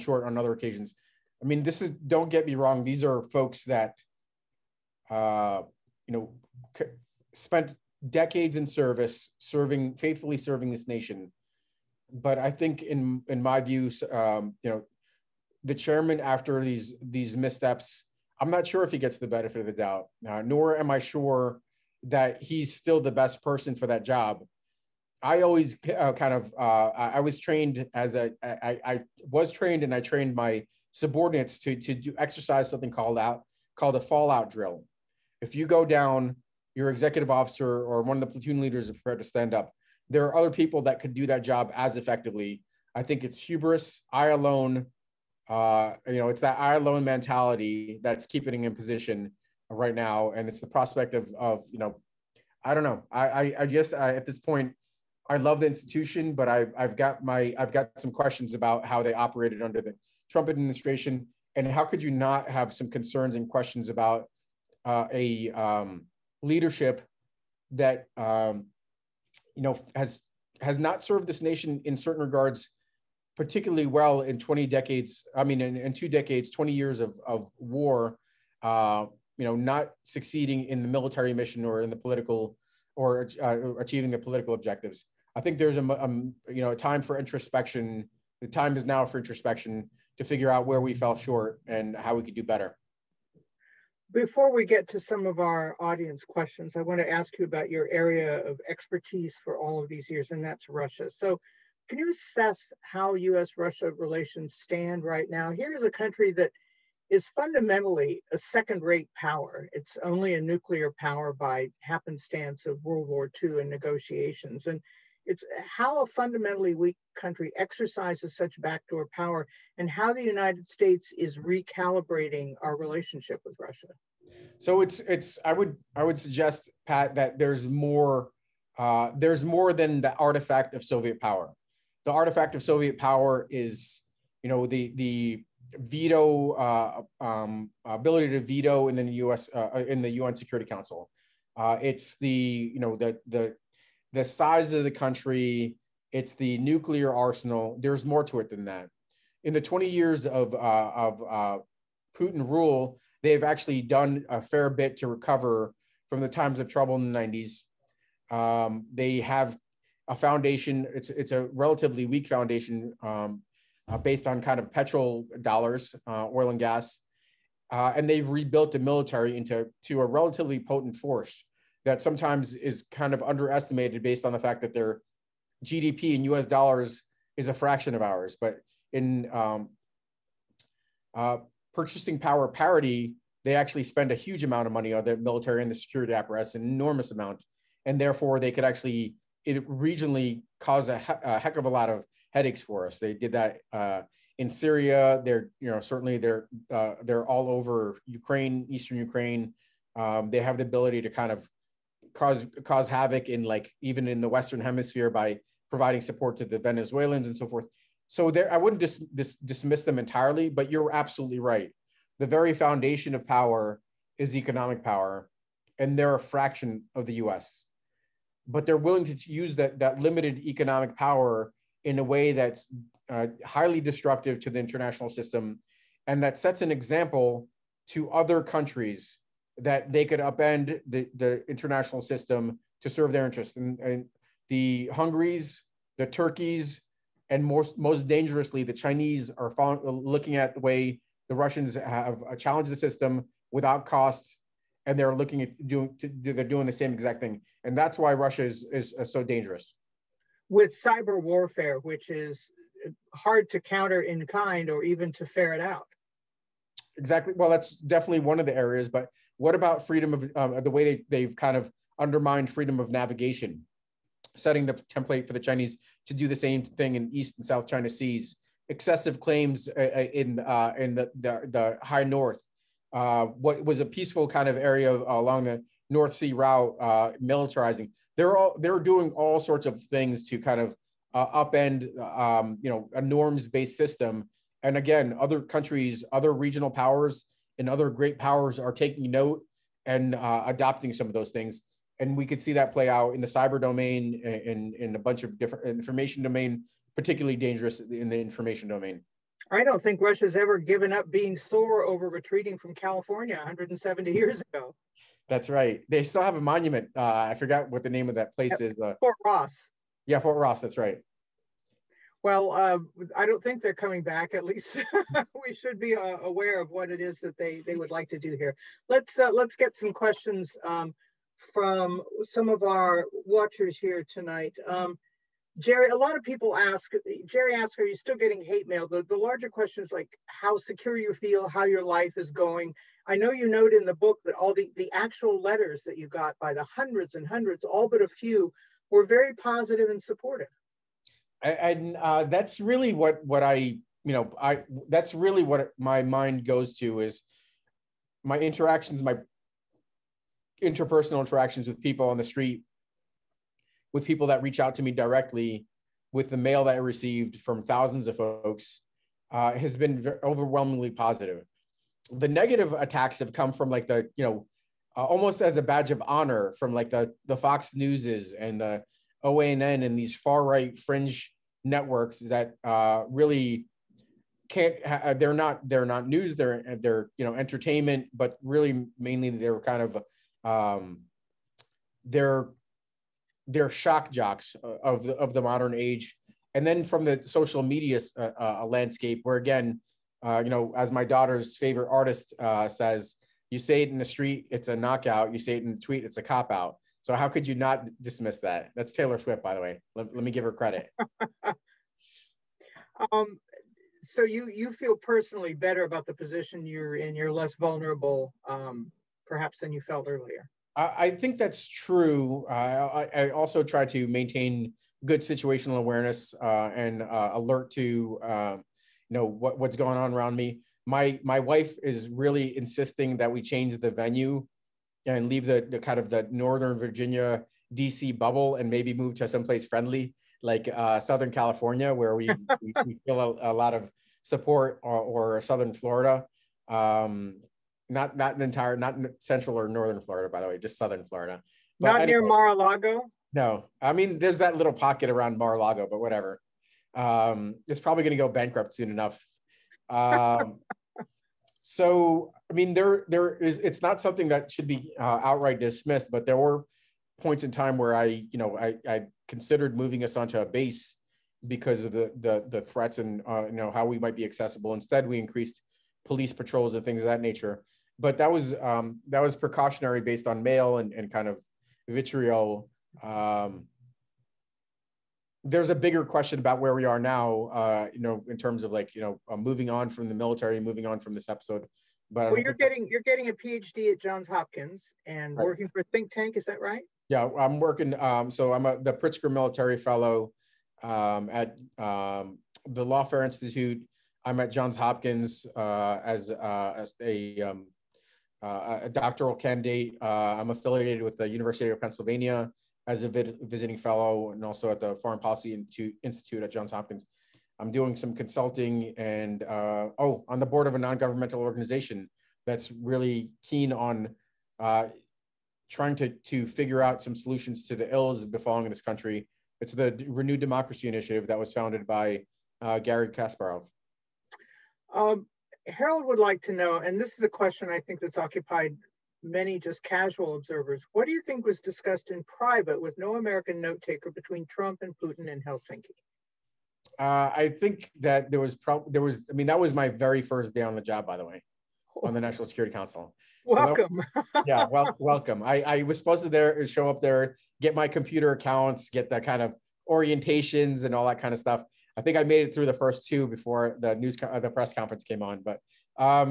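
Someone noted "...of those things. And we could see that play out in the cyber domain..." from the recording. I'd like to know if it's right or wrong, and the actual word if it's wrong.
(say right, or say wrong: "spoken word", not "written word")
right.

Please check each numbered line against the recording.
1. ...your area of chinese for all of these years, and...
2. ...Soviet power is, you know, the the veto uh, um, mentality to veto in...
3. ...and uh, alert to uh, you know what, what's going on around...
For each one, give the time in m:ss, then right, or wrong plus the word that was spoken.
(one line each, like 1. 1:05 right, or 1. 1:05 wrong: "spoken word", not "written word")
1. 1:37 wrong: "expertise", not "chinese"
2. 2:12 wrong: "ability", not "mentality"
3. 6:56 right.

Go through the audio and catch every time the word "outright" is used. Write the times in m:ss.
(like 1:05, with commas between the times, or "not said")
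7:35.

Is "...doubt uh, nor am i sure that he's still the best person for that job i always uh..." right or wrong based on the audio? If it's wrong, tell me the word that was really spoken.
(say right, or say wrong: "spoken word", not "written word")
right.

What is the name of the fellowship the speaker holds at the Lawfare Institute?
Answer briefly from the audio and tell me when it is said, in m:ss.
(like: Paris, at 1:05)
Pritzker Military Fellow, at 8:08.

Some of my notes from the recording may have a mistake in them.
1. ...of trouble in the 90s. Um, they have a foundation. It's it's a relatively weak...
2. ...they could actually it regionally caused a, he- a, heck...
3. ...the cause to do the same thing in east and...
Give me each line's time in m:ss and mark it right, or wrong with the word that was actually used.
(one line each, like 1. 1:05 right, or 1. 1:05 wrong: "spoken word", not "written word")
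1. 2:36 right
2. 3:08 right
3. 4:25 wrong: "chinese", not "cause".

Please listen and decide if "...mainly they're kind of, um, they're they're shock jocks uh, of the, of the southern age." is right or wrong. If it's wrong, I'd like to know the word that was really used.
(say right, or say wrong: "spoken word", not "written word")
wrong: "modern", not "southern".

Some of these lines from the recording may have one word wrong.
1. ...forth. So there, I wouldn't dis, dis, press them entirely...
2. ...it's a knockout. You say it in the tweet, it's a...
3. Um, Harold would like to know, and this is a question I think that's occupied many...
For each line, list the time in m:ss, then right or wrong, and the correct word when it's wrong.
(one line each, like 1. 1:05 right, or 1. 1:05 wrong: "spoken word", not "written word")
1. 3:27 wrong: "dismiss", not "press"
2. 6:34 right
3. 8:44 right.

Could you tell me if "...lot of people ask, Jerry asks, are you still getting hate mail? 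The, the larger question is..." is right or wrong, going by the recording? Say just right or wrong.
right.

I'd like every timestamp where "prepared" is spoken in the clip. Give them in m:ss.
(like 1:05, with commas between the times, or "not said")
0:38.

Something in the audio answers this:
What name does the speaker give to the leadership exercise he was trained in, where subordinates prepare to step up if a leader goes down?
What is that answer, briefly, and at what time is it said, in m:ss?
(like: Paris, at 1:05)
Fallout drill, at 0:34.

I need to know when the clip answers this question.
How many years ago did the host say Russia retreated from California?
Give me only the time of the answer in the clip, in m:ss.
5:03.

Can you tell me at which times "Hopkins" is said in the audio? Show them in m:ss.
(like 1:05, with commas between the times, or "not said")
8:04, 8:14, 8:26.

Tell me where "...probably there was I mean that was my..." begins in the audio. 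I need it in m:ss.
8:58.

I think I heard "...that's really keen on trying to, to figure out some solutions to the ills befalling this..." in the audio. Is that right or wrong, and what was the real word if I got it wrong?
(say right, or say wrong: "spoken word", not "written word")
right.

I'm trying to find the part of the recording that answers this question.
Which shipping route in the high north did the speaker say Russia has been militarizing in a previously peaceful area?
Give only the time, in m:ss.
4:35.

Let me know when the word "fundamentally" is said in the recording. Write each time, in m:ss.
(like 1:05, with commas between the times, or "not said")
1:47, 1:56.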